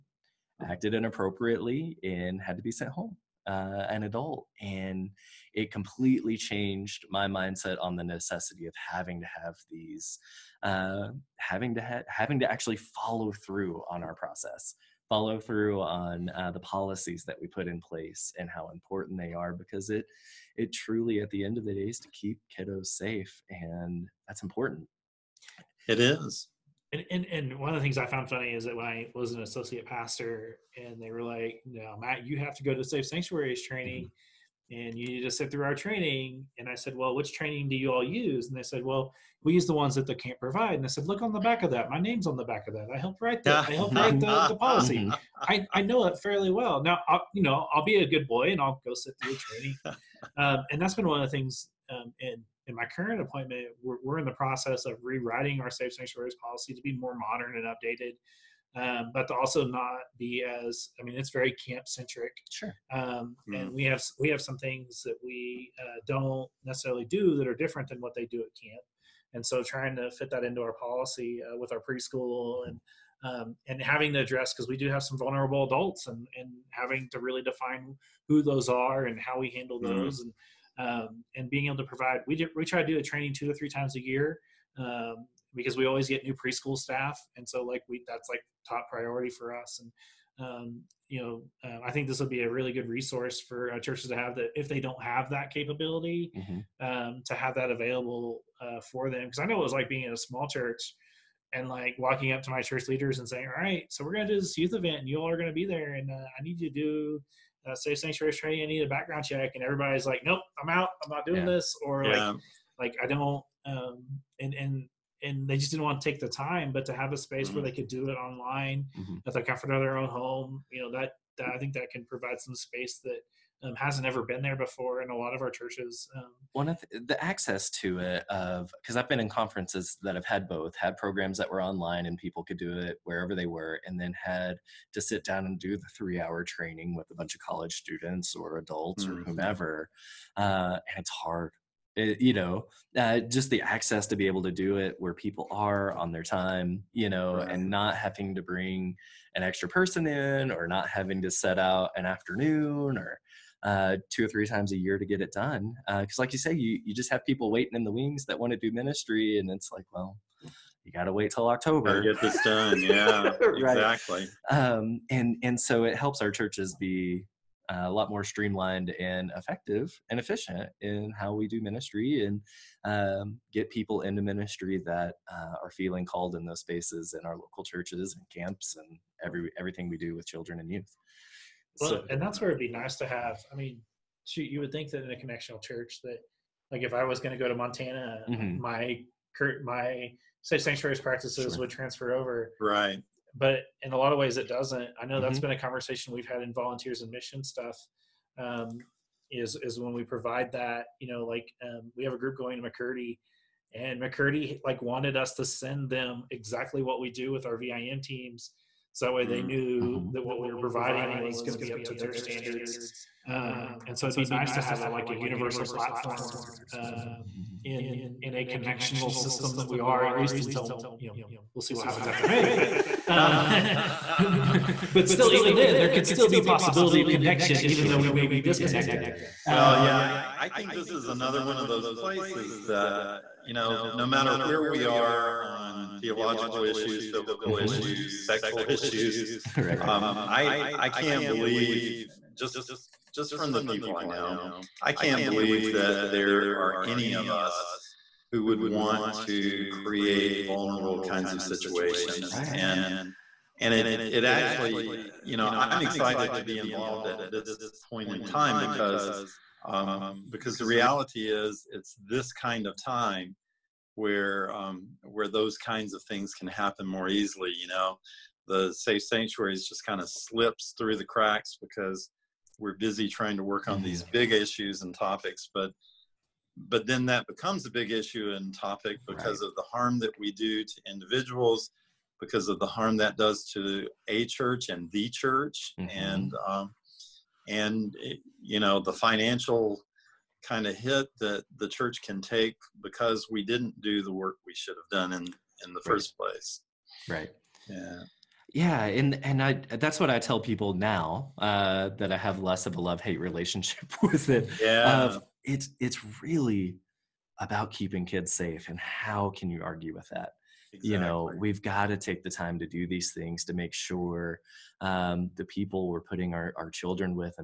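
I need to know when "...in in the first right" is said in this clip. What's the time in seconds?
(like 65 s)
295 s.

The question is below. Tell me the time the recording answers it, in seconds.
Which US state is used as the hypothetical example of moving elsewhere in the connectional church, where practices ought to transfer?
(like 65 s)
187 s.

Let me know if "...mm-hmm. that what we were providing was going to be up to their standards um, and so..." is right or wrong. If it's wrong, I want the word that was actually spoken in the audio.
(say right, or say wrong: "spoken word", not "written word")
right.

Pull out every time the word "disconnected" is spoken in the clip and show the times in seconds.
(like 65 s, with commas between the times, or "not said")
228 s.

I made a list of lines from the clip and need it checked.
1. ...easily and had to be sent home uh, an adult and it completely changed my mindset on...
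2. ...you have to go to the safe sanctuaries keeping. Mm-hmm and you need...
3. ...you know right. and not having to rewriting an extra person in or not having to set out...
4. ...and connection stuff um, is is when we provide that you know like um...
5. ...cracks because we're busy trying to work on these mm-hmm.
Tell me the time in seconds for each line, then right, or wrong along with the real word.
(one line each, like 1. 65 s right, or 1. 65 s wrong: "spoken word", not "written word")
1. 0 s wrong: "inappropriately", not "easily"
2. 32 s wrong: "training", not "keeping"
3. 146 s wrong: "bring", not "rewriting"
4. 197 s wrong: "mission", not "connection"
5. 271 s right.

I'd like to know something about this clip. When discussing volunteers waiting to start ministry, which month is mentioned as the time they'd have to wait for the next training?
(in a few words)
October.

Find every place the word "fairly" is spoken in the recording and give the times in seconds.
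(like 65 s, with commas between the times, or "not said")
46 s.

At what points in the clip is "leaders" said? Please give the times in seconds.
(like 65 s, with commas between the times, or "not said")
102 s.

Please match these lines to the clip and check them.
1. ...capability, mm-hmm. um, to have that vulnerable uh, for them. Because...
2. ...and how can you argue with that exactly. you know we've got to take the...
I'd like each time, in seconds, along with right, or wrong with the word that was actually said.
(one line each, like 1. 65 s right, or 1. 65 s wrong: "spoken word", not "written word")
1. 95 s wrong: "available", not "vulnerable"
2. 308 s right.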